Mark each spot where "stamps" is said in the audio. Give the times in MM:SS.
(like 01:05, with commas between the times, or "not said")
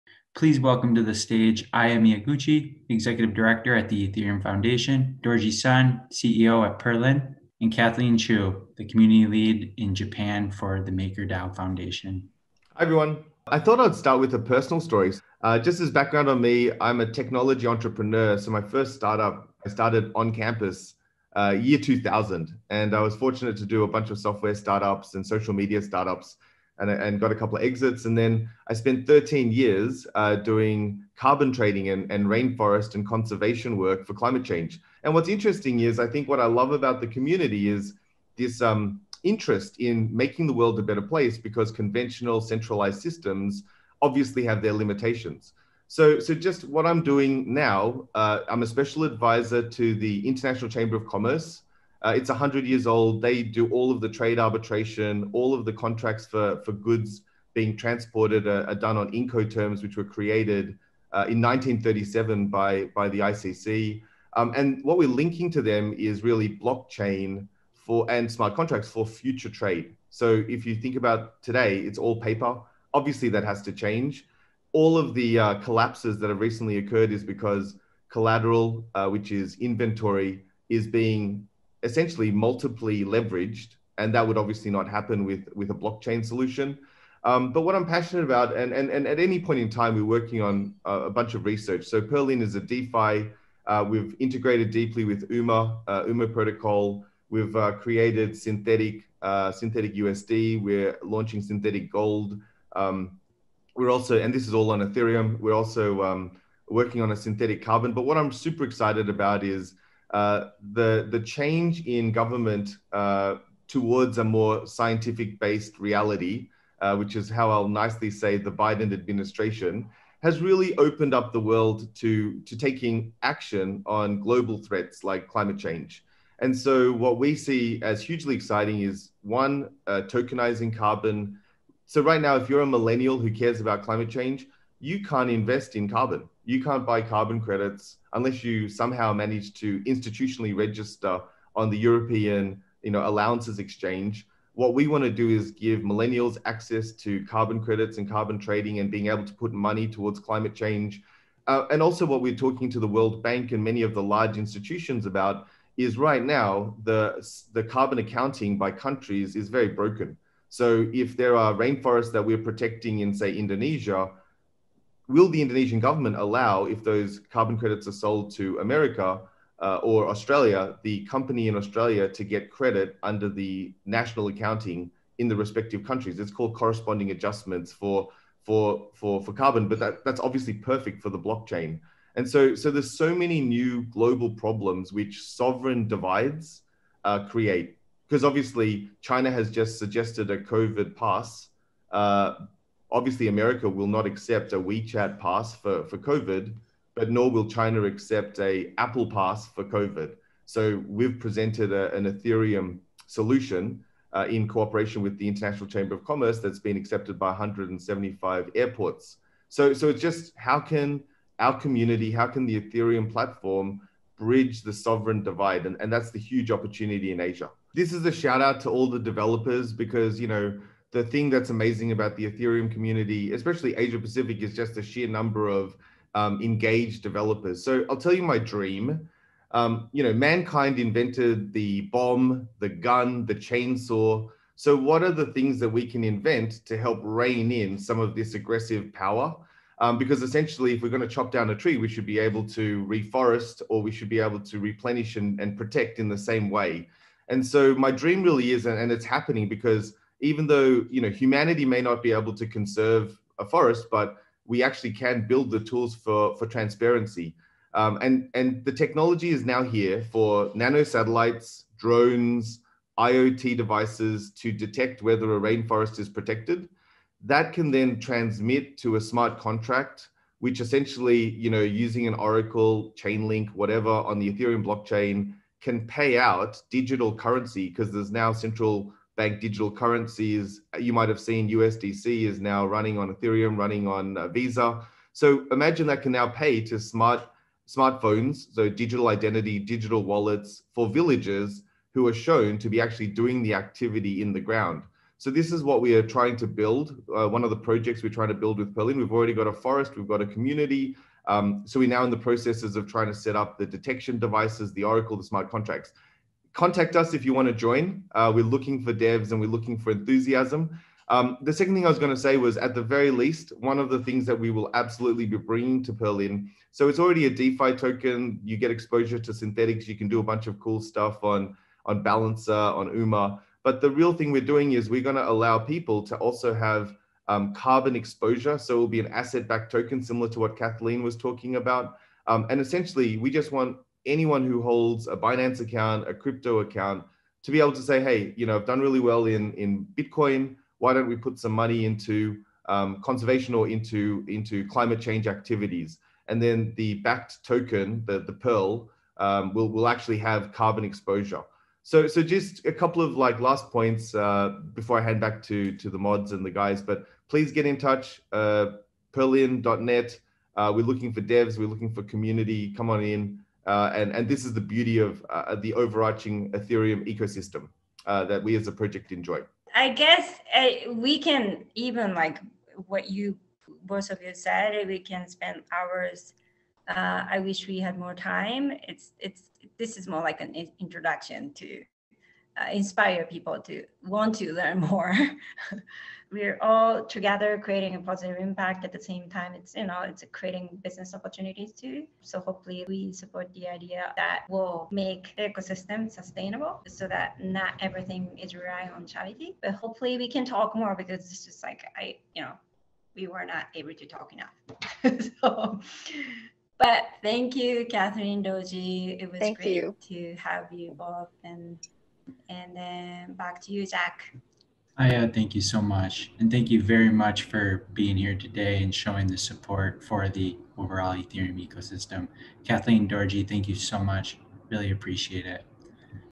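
not said.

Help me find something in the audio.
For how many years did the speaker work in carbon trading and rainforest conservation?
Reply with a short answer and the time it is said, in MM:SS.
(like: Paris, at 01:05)
13, at 00:29.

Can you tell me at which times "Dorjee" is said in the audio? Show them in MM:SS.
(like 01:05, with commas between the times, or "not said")
00:05, 06:48, 07:03.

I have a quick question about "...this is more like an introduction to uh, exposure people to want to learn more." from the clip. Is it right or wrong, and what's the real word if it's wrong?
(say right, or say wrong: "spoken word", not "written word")
wrong: "inspire", not "exposure".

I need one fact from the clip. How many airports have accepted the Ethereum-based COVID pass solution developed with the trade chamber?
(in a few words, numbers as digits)
175.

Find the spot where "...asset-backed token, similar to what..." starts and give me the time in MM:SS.
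05:29.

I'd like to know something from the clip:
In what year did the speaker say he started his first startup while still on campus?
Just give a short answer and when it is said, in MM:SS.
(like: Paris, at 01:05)
2000, at 00:21.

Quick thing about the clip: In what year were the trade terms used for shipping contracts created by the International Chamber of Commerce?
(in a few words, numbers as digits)
1937.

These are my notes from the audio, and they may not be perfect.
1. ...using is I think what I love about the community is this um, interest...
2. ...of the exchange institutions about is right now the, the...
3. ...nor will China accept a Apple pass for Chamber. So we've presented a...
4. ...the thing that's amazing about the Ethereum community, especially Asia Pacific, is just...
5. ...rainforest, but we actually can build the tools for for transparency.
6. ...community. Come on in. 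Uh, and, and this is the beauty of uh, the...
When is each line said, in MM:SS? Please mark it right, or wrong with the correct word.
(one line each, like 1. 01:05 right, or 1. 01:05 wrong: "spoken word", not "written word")
1. 00:35 wrong: "interesting", not "using"
2. 02:33 wrong: "large", not "exchange"
3. 03:17 wrong: "COVID", not "Chamber"
4. 03:40 right
5. 04:13 wrong: "forest", not "rainforest"
6. 06:02 right.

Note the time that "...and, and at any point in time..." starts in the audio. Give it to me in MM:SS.
01:28.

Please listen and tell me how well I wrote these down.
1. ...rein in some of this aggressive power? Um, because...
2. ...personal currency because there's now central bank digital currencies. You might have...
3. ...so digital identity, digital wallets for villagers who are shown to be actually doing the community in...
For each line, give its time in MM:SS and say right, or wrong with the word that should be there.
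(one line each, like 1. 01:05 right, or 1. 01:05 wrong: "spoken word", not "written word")
1. 03:57 right
2. 04:36 wrong: "digital", not "personal"
3. 04:48 wrong: "activity", not "community".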